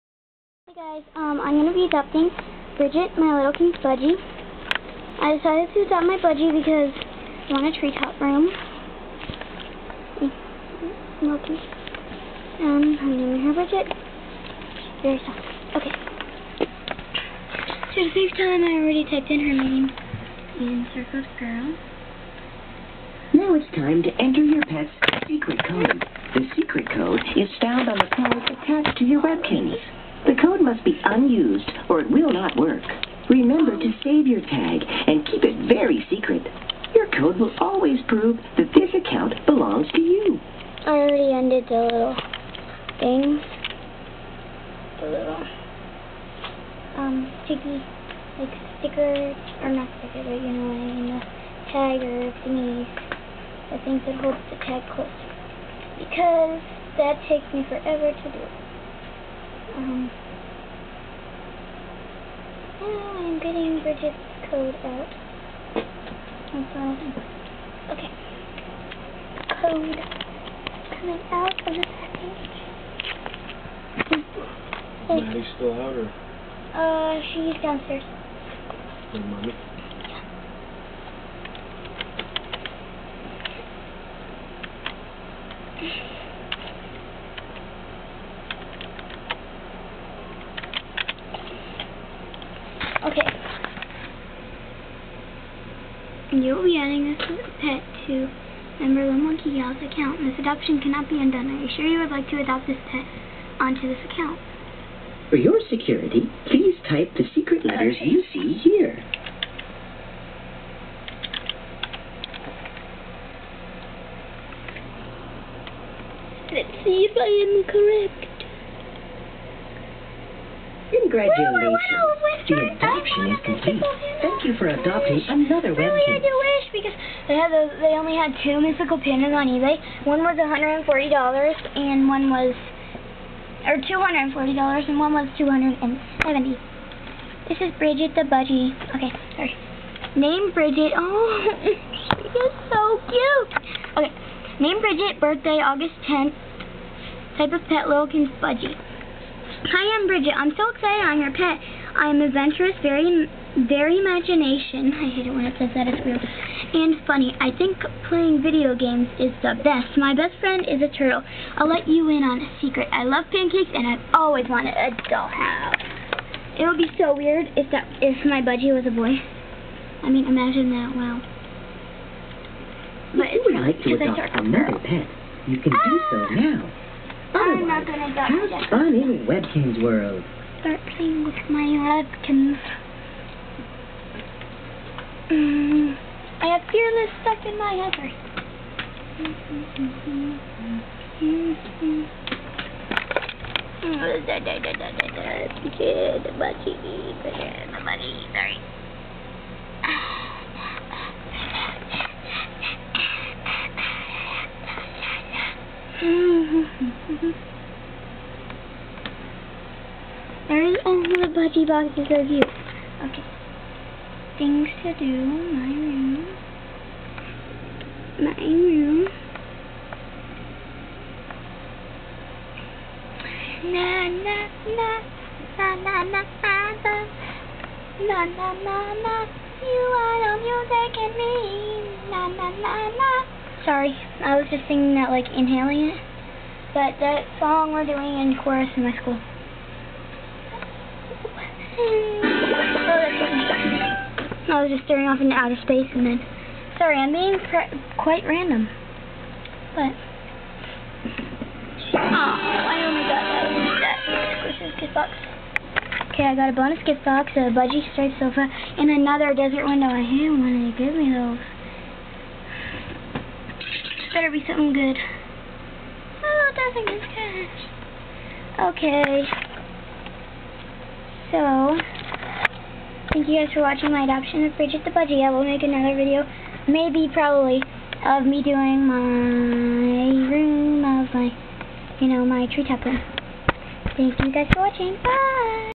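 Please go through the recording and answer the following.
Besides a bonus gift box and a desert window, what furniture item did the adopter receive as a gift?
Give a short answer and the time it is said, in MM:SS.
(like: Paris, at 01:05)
budgie striped sofa, at 04:17.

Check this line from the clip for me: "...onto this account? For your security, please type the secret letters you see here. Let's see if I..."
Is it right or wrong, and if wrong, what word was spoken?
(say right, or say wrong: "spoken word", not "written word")
right.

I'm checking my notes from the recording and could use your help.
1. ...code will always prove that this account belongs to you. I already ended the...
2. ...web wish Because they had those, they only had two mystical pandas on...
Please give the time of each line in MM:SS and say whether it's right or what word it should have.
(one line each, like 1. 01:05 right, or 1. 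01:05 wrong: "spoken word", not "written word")
1. 00:37 right
2. 02:05 right.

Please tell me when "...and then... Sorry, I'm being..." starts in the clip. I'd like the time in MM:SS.
04:05.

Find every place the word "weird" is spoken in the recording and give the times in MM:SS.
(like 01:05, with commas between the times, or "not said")
02:36, 02:47.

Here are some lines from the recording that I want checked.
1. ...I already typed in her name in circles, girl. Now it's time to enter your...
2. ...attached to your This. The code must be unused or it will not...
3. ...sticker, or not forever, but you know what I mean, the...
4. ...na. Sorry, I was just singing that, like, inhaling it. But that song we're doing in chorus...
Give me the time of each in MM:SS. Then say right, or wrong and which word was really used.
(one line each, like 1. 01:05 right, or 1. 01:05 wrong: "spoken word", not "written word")
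1. 00:18 right
2. 00:28 wrong: "Webkinz", not "This"
3. 00:48 wrong: "sticker", not "forever"
4. 03:52 right.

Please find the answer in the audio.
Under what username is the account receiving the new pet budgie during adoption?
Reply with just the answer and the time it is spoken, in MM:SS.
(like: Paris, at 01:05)
Merlin Monkey Gal, at 01:39.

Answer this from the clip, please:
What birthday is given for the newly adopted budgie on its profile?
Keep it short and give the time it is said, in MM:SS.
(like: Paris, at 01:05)
August 10th, at 02:25.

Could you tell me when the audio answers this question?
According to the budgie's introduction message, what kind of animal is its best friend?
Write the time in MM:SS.
02:40.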